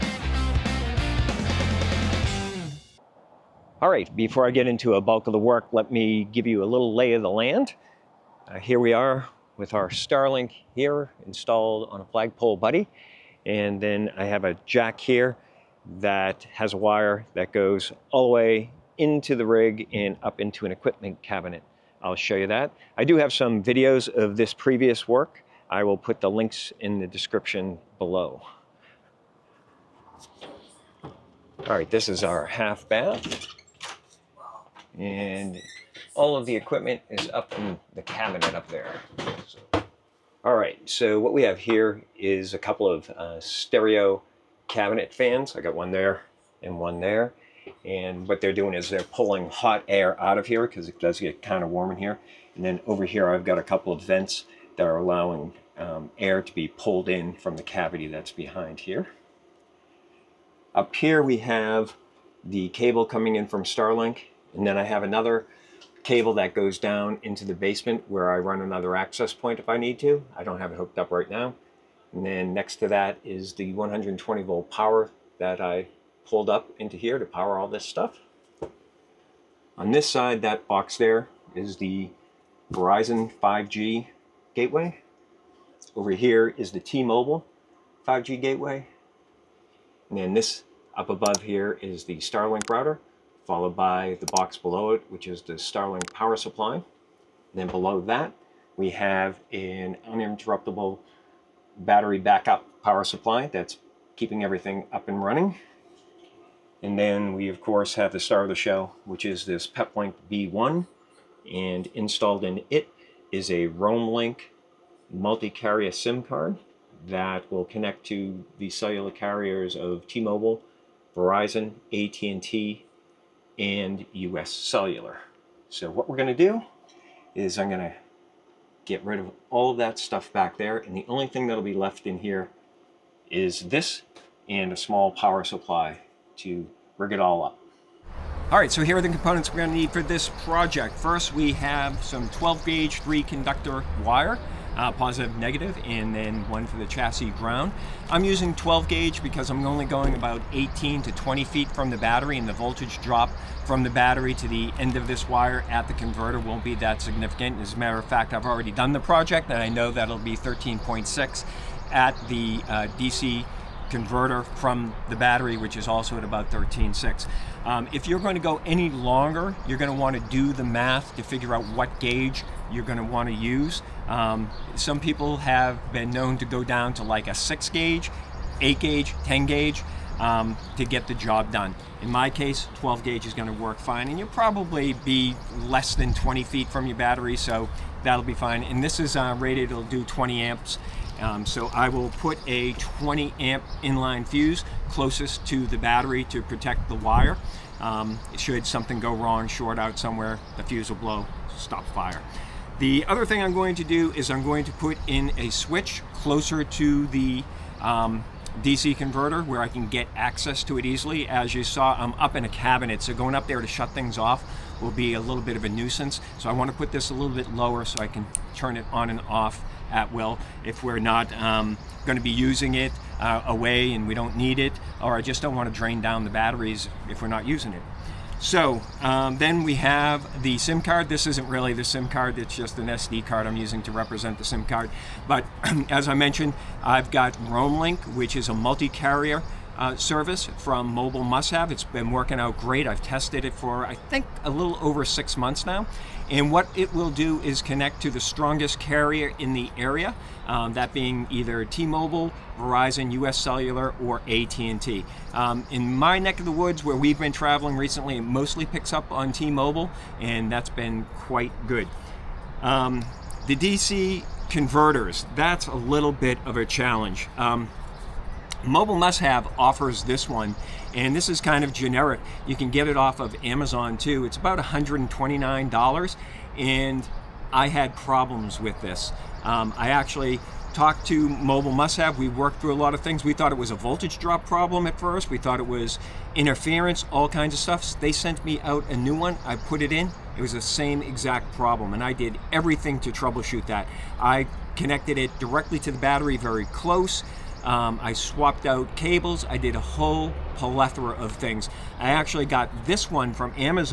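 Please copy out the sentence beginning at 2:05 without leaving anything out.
So what we're going to do is I'm going to get rid of all of that stuff back there.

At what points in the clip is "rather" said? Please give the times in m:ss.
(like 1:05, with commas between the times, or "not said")
not said.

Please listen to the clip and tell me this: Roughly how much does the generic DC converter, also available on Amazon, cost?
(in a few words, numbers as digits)
$129.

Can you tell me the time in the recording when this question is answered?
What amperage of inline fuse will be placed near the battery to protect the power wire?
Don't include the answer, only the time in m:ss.
3:12.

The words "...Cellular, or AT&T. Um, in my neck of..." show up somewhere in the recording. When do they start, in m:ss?
4:13.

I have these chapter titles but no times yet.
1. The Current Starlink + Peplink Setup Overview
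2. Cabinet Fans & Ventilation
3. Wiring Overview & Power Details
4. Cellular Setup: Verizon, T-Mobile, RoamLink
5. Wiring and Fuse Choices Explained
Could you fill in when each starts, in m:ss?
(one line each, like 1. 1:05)
1. 0:23
2. 1:03
3. 1:48
4. 2:43
5. 4:18.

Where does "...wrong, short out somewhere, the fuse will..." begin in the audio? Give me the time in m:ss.
3:19.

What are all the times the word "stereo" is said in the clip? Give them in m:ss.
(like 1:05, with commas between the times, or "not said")
0:43.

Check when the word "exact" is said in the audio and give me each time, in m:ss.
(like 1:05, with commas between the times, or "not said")
4:51.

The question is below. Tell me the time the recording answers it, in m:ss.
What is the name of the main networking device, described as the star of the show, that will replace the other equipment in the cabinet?
1:49.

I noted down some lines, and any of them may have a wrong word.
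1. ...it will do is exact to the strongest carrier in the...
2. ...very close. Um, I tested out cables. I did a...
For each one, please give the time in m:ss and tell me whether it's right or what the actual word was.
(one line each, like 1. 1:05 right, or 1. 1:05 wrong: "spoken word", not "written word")
1. 4:06 wrong: "connect", not "exact"
2. 4:56 wrong: "swapped", not "tested".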